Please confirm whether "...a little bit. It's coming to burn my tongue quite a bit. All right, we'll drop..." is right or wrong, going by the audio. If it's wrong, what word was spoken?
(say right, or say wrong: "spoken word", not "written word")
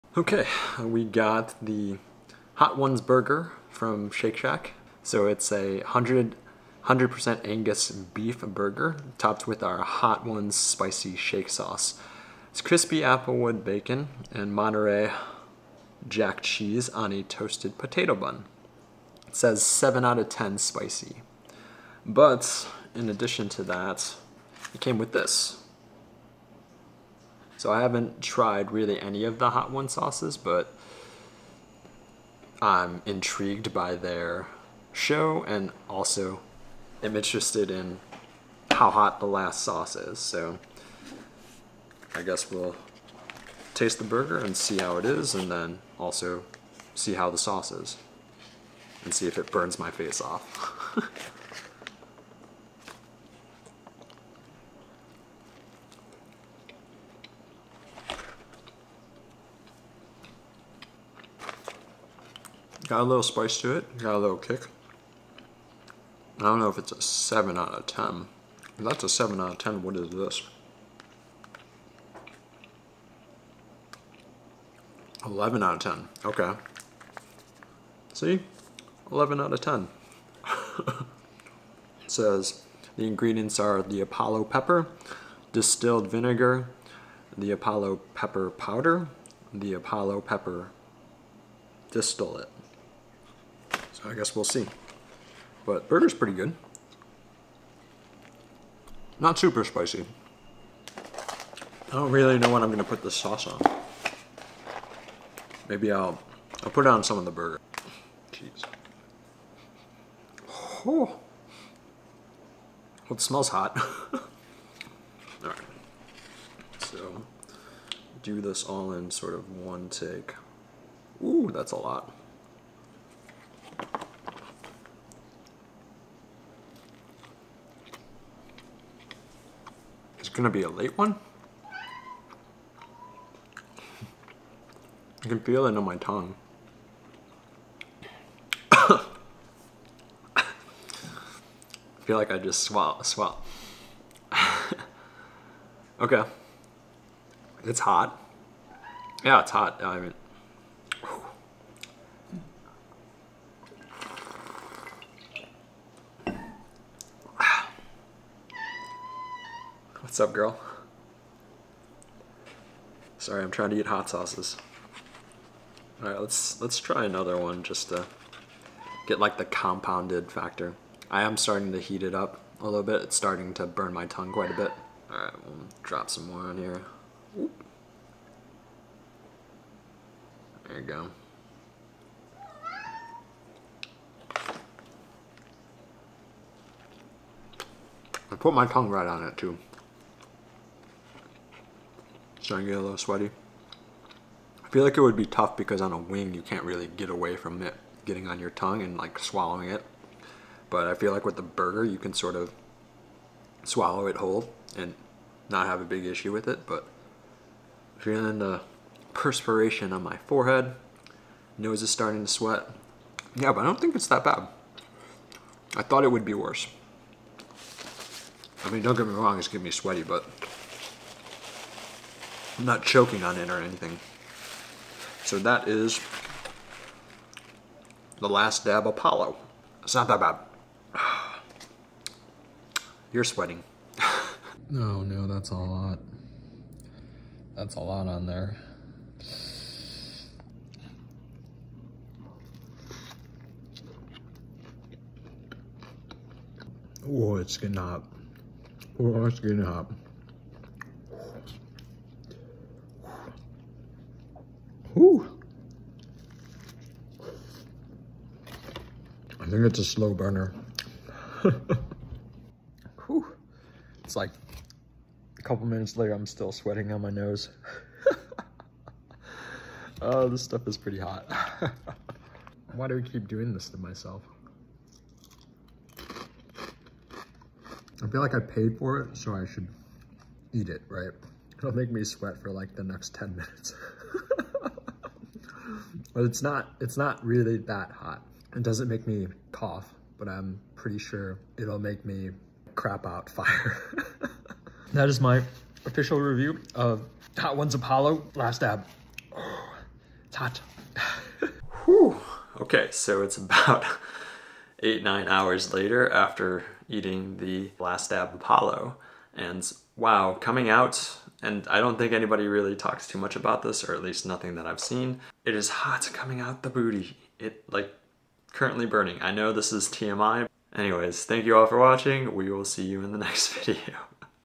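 wrong: "starting", not "coming".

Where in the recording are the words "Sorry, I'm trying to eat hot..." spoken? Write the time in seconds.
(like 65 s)
163 s.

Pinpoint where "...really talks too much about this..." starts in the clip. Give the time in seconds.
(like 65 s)
312 s.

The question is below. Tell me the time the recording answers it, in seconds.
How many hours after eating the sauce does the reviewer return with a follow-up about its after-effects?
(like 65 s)
304 s.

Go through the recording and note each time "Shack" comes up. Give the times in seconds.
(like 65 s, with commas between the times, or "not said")
4 s, 11 s.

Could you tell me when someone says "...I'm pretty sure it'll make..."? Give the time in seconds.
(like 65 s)
290 s.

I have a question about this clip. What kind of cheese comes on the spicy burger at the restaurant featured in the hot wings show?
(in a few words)
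Monterey jack.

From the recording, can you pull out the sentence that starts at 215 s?
I thought it would be worse.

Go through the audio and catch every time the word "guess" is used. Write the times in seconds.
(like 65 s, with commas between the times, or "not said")
42 s, 94 s.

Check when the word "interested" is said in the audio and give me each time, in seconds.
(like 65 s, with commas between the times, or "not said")
37 s.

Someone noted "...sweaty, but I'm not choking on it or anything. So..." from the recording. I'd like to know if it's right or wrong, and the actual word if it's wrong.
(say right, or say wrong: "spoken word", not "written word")
right.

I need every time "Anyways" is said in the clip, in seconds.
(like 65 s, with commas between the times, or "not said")
320 s.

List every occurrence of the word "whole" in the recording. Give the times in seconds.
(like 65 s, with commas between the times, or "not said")
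204 s.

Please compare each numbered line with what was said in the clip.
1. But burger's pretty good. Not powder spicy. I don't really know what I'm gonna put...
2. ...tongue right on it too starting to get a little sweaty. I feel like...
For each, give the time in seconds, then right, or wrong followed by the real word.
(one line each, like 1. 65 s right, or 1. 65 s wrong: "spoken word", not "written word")
1. 95 s wrong: "super", not "powder"
2. 188 s right.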